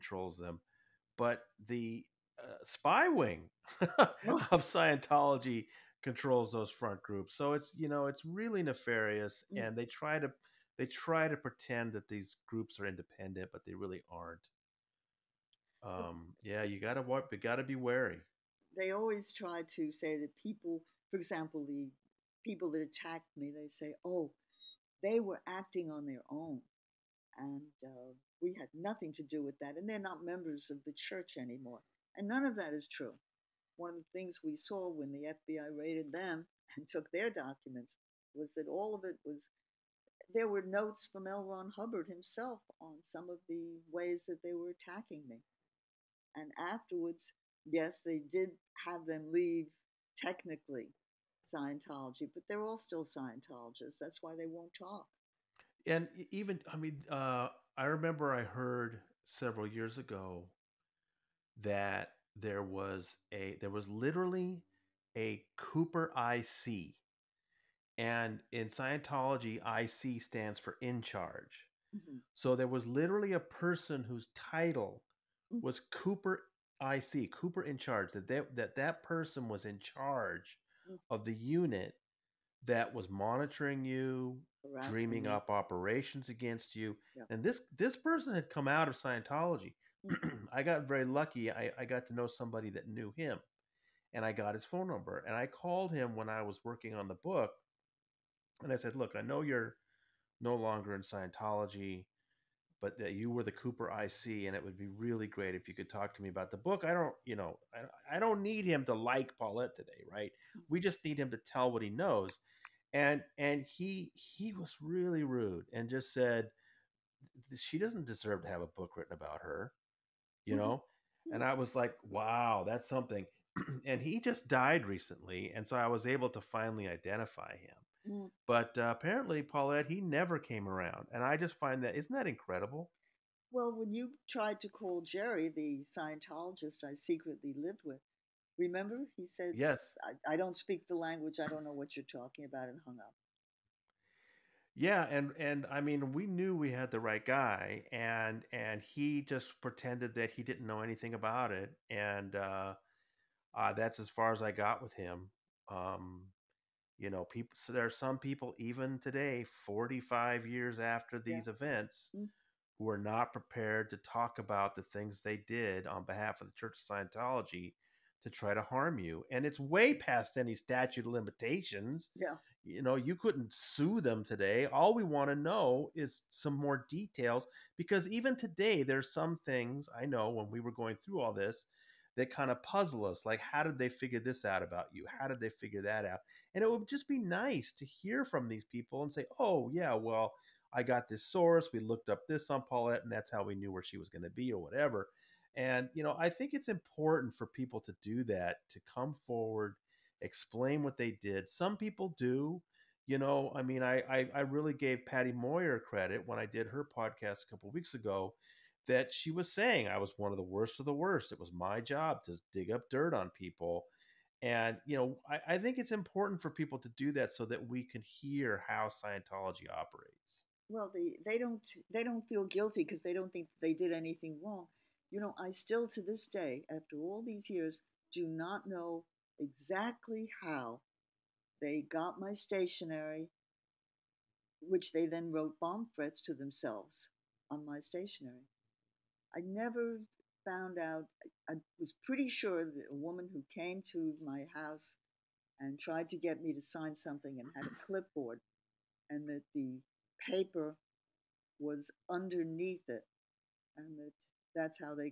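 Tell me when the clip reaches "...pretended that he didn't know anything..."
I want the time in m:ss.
2:29.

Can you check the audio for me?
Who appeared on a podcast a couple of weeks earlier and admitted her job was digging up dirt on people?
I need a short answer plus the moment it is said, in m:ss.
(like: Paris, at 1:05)
Patty Moher, at 3:25.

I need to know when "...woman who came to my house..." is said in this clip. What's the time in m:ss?
4:02.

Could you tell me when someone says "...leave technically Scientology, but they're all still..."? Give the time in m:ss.
0:49.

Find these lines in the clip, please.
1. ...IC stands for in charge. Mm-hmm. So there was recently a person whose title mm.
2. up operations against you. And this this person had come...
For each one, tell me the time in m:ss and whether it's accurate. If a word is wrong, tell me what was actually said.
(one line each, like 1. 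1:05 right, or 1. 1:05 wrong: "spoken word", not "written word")
1. 1:09 wrong: "literally", not "recently"
2. 1:25 right.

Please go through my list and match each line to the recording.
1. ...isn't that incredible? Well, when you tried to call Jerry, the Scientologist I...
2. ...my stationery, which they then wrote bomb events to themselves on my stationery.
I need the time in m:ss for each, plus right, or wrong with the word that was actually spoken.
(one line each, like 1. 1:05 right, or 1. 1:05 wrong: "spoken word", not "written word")
1. 2:11 right
2. 3:52 wrong: "threats", not "events".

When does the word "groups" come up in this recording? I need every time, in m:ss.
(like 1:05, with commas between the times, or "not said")
0:07, 0:12.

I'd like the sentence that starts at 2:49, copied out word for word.
And it's way past any statute of limitations.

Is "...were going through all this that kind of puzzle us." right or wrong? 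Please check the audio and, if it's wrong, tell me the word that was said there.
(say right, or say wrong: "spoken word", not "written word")
right.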